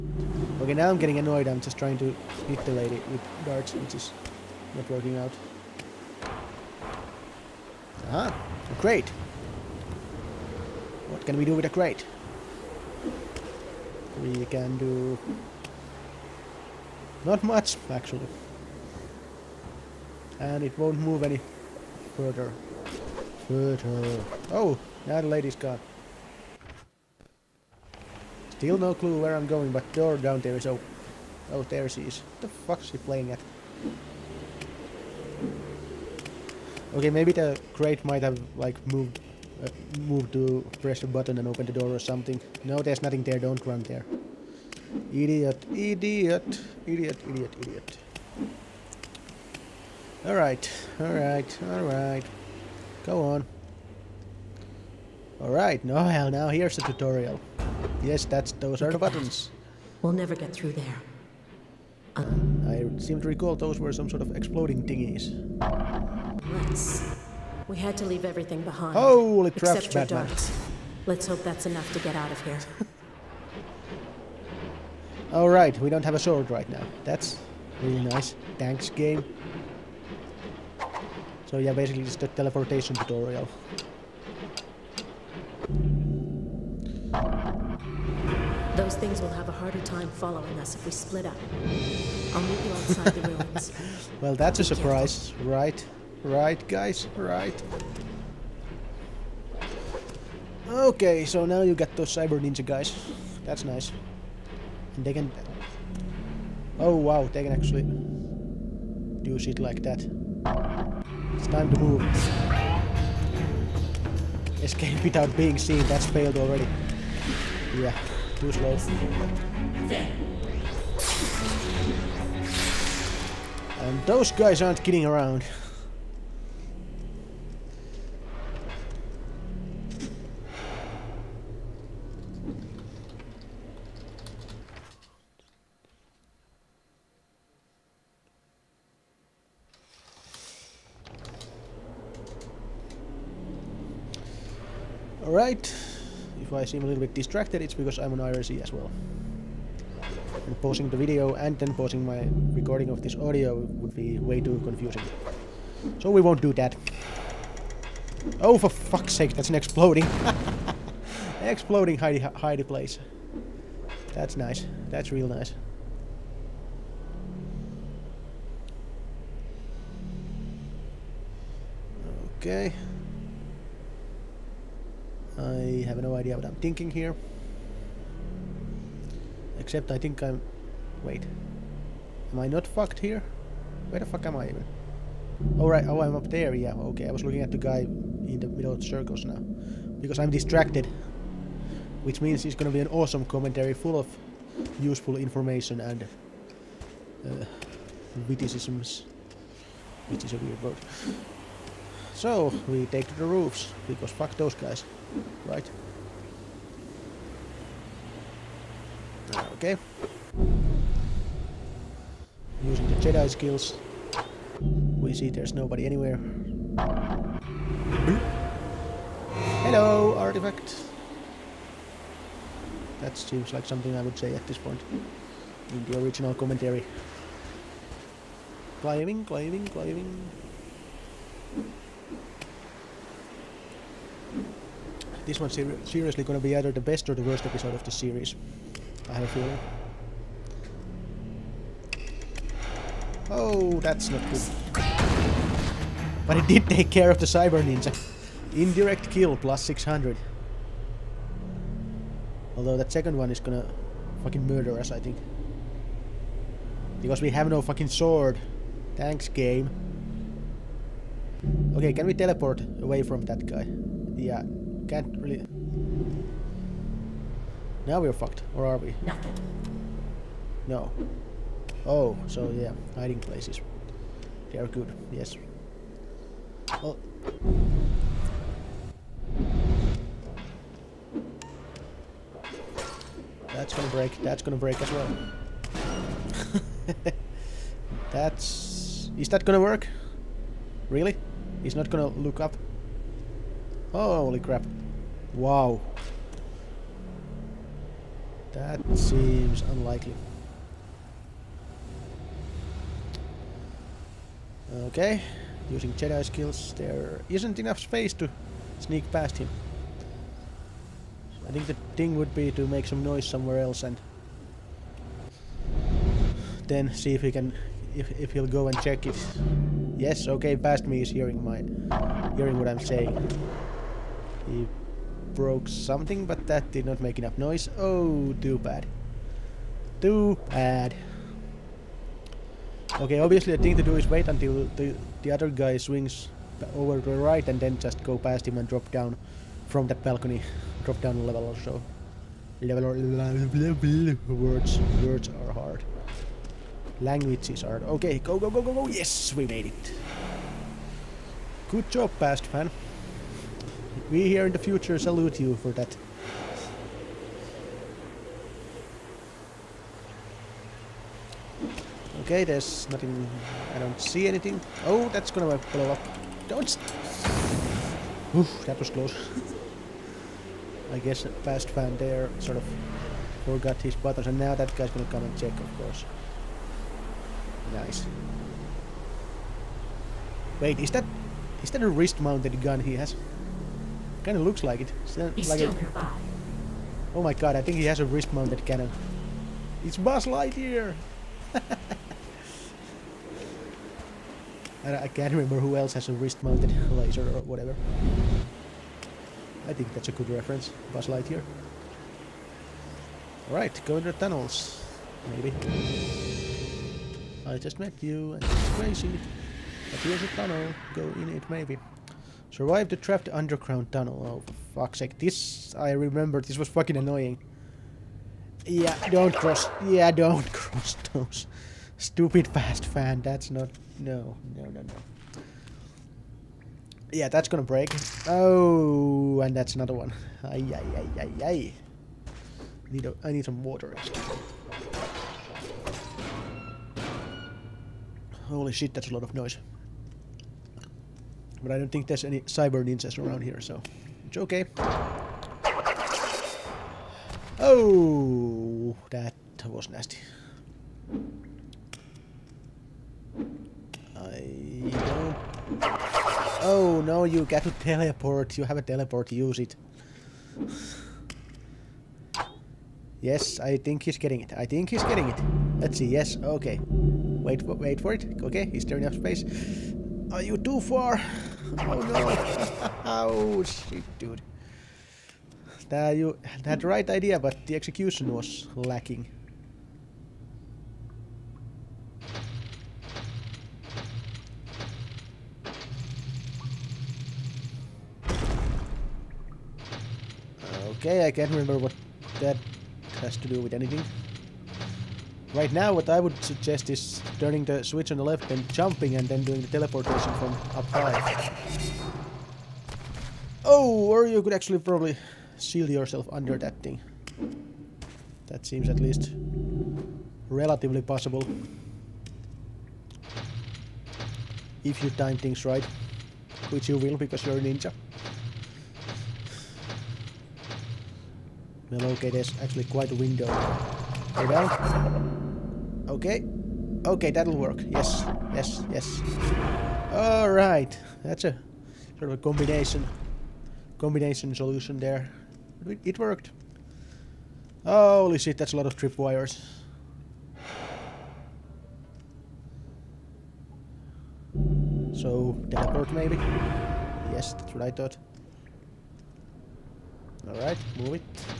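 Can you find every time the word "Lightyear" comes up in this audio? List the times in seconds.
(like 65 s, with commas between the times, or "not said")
390 s, 401 s.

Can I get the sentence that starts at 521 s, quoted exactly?
Well, okay, there's actually quite a window.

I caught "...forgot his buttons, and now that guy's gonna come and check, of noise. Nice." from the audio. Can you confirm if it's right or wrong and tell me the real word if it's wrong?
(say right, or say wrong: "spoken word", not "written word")
wrong: "course", not "noise".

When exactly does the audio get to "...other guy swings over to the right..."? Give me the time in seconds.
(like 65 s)
335 s.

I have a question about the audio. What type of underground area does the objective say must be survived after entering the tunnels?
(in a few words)
Trapped underground tunnel.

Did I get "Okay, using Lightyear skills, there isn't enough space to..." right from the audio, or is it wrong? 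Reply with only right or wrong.
wrong.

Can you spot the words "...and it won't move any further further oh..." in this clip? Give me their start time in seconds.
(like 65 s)
20 s.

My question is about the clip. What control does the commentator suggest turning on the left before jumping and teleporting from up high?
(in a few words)
The switch.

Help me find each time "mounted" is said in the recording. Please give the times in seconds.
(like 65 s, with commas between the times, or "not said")
381 s, 388 s, 396 s.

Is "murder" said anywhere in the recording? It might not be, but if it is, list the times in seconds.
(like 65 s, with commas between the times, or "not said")
254 s.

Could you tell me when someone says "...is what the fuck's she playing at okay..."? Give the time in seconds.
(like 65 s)
32 s.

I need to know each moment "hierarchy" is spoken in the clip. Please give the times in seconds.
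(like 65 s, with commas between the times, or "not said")
not said.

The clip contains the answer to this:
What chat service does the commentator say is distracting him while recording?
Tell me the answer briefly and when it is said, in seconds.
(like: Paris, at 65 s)
IRC, at 148 s.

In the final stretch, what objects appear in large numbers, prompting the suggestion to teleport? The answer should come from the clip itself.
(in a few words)
Tripwires.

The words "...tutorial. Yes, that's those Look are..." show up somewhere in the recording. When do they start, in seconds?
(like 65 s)
56 s.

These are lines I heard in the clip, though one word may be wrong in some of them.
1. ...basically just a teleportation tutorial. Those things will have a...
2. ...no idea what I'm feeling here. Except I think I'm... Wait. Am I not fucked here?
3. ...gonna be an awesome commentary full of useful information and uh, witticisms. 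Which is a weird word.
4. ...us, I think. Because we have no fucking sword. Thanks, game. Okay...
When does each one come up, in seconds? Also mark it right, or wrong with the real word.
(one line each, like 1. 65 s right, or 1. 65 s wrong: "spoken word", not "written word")
1. 81 s right
2. 176 s wrong: "thinking", not "feeling"
3. 192 s right
4. 254 s right.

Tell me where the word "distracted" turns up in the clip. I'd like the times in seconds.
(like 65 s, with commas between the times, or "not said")
147 s, 190 s.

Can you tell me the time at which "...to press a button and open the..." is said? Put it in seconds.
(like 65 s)
40 s.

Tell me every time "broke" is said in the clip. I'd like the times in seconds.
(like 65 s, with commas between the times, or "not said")
325 s.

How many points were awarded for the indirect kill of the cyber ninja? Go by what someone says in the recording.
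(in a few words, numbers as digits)
600.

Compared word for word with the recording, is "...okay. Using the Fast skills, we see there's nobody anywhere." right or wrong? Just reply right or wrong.
wrong.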